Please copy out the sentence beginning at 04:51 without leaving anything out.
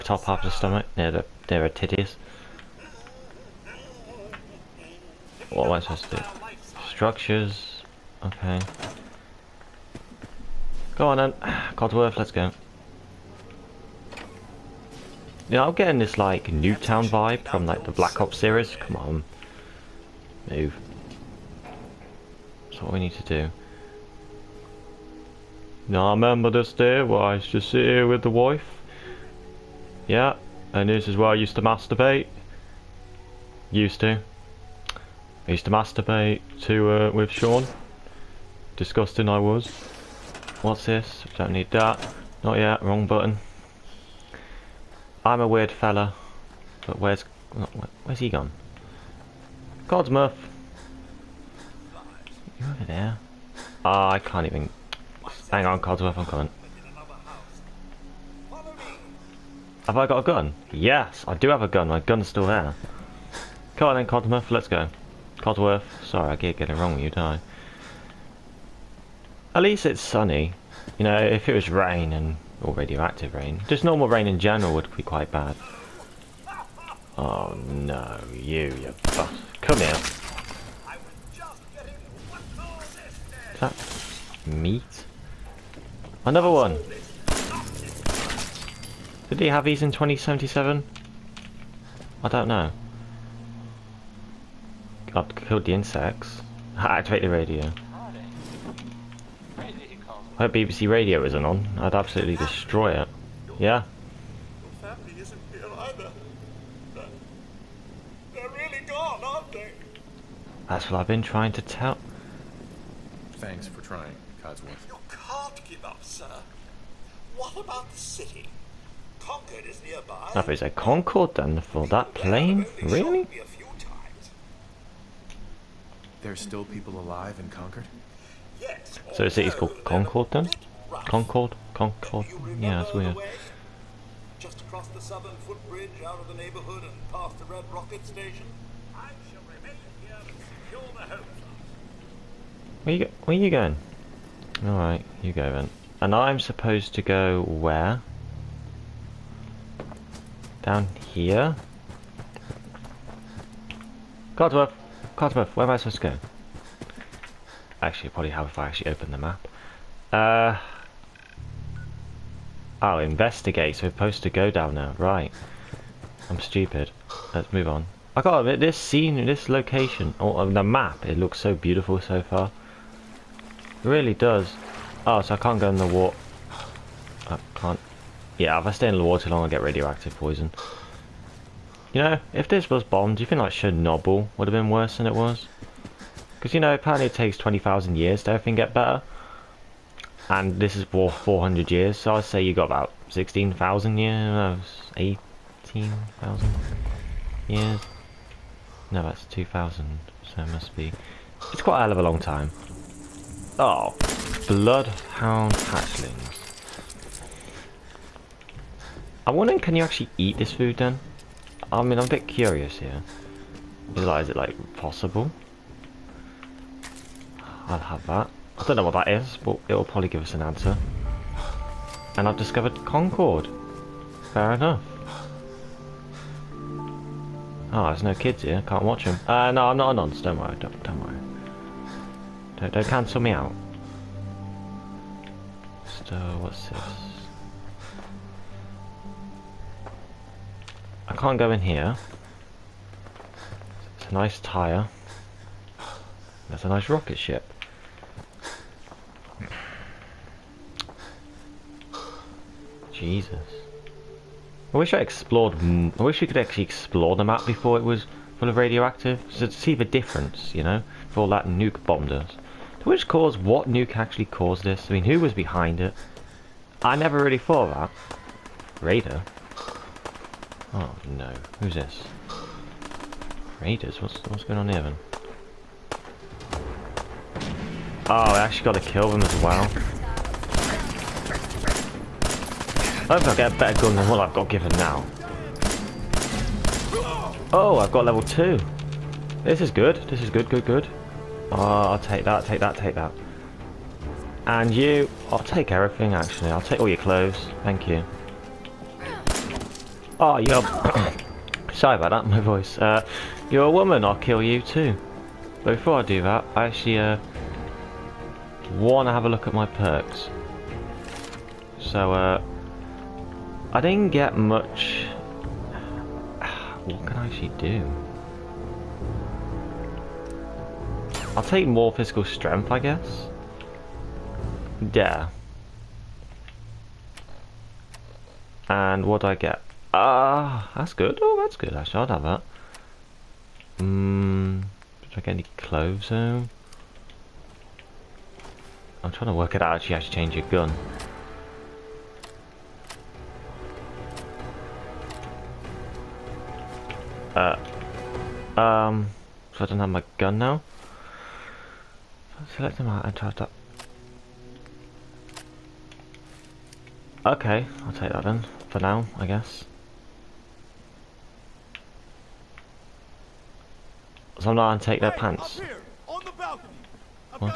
Oh, I'll take that, take that, take that.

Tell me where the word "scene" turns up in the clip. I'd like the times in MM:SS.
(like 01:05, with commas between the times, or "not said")
02:48.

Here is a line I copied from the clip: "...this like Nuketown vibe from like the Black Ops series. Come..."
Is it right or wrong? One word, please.
right.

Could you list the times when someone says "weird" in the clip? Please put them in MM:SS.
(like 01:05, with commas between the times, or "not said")
00:45, 02:12.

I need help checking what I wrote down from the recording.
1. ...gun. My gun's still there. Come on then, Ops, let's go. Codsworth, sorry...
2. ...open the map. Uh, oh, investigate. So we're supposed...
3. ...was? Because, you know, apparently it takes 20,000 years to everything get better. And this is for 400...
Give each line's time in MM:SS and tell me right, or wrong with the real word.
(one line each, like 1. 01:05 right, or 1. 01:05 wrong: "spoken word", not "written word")
1. 01:01 wrong: "Codsworth", not "Ops"
2. 02:38 right
3. 03:05 right.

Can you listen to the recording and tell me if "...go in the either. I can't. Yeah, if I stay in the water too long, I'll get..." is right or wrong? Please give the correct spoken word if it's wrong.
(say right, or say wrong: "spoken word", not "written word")
wrong: "water", not "either".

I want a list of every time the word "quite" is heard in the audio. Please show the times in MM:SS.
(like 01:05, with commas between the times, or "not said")
01:15, 03:21.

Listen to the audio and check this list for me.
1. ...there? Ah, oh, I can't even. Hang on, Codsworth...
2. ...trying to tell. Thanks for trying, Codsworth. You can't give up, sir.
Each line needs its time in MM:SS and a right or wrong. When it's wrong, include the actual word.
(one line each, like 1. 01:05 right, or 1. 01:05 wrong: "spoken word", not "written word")
1. 00:52 right
2. 01:51 right.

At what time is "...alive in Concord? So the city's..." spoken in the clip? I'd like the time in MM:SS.
02:06.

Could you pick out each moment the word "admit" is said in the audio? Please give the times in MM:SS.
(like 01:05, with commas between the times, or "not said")
02:48.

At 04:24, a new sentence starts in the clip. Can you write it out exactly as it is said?
I mean, who was behind it?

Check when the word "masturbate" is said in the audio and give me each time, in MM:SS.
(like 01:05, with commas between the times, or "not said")
00:31, 00:35.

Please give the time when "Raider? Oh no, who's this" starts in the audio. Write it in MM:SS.
04:28.